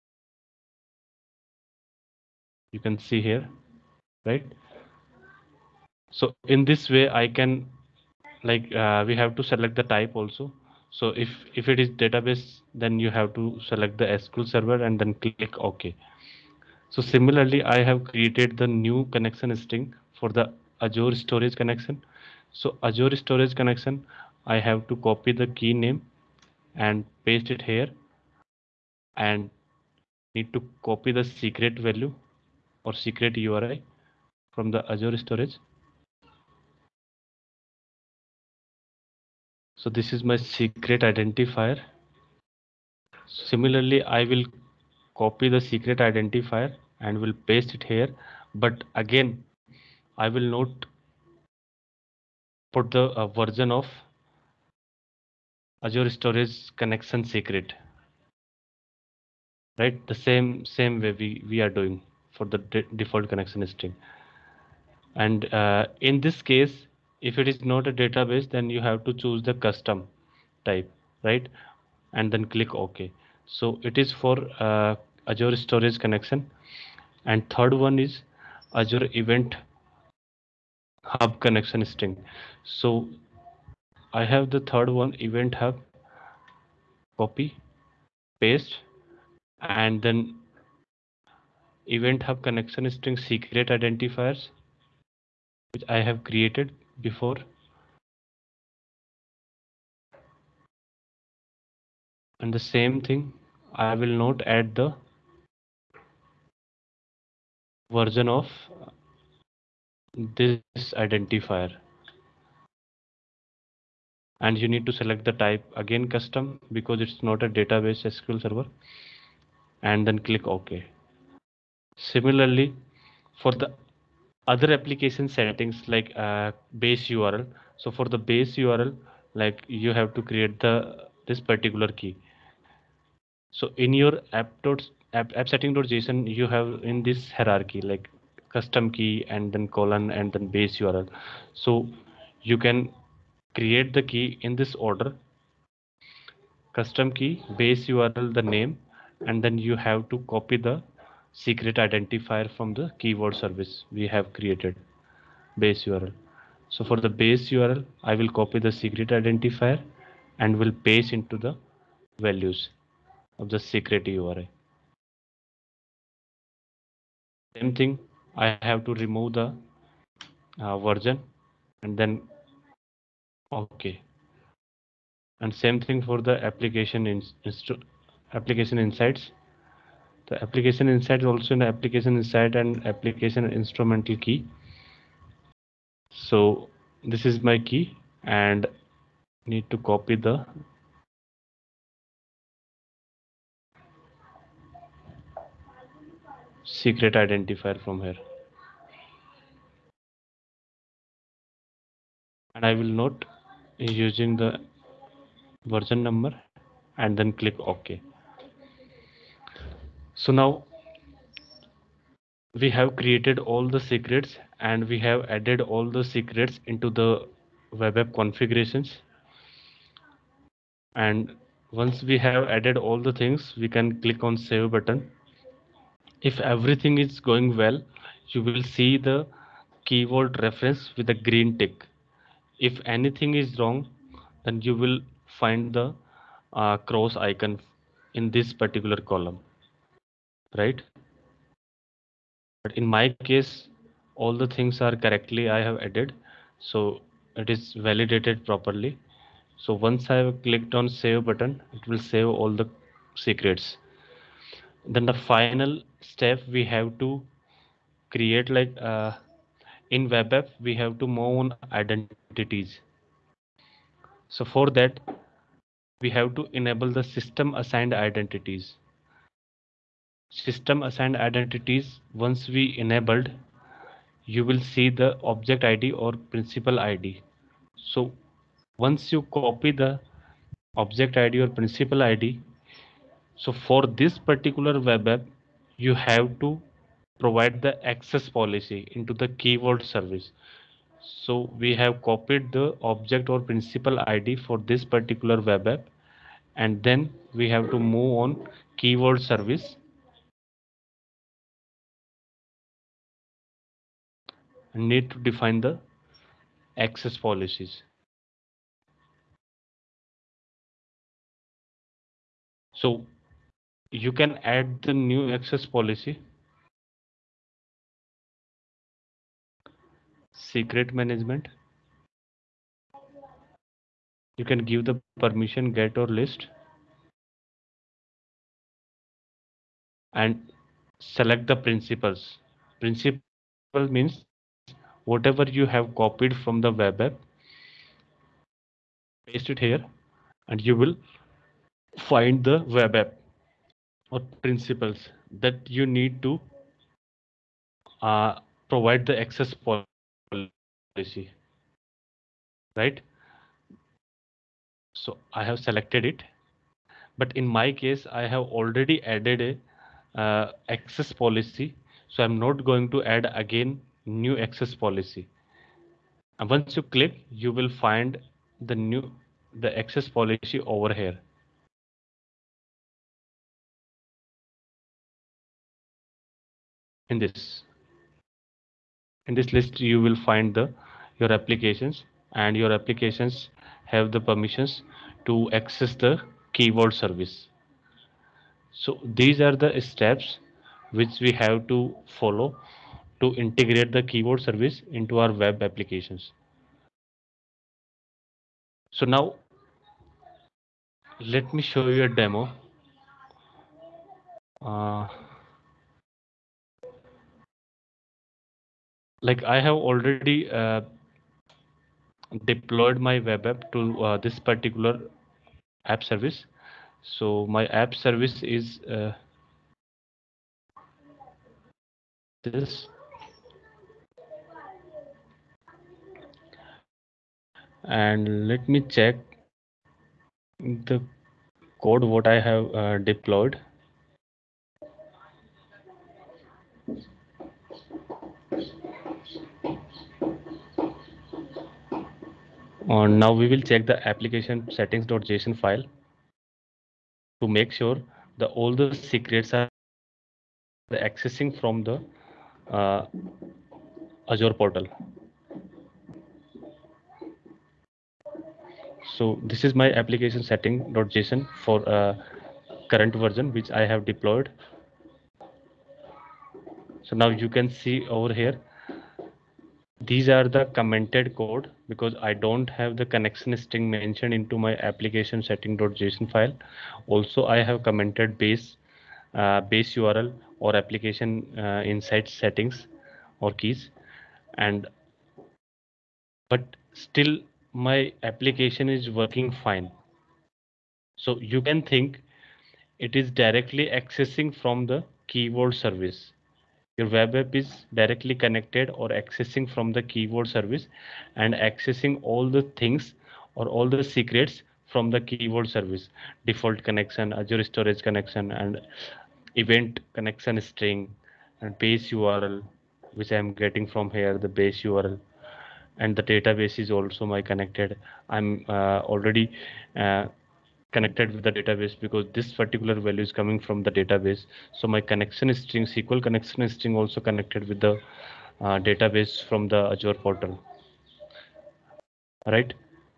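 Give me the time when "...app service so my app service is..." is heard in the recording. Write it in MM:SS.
06:55.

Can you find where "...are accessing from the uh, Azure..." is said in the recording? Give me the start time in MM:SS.
07:29.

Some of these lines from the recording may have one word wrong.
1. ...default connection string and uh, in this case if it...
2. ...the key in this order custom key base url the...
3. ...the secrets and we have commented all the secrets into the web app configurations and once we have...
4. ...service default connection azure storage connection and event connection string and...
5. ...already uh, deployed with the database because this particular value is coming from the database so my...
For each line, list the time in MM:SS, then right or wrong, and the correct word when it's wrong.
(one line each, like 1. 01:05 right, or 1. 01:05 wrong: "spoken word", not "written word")
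1. 01:03 right
2. 02:23 right
3. 03:33 wrong: "added", not "commented"
4. 08:25 right
5. 08:39 wrong: "connected", not "deployed".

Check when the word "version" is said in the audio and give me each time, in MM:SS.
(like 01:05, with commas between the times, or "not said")
00:53, 01:47, 02:50, 03:25, 07:43.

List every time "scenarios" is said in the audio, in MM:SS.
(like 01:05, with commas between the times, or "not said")
not said.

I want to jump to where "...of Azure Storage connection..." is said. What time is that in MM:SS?
00:53.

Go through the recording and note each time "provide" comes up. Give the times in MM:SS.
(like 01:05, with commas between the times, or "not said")
04:47, 05:48.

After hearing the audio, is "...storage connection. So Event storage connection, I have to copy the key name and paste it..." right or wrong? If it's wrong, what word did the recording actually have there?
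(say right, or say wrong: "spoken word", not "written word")
wrong: "Azure", not "Event".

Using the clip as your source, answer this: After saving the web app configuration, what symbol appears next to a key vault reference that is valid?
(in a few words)
green tick.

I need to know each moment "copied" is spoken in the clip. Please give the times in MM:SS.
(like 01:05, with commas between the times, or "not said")
04:52, 05:36.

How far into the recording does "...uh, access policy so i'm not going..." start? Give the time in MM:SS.
06:00.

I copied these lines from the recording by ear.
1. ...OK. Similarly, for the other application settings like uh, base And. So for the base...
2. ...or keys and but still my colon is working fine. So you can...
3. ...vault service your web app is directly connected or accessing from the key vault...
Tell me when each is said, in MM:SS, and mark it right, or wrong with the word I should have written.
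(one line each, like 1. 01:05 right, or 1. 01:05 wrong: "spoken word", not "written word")
1. 02:00 wrong: "URL", not "And"
2. 08:03 wrong: "application", not "colon"
3. 08:15 right.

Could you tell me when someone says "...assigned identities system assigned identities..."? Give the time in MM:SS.
04:27.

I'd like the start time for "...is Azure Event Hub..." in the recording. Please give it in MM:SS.
01:17.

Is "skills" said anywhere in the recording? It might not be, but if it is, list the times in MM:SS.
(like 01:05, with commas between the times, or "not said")
not said.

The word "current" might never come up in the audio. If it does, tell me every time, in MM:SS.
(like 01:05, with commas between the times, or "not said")
07:42.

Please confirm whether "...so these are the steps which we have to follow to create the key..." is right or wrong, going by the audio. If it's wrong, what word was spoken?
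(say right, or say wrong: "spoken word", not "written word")
wrong: "integrate", not "create".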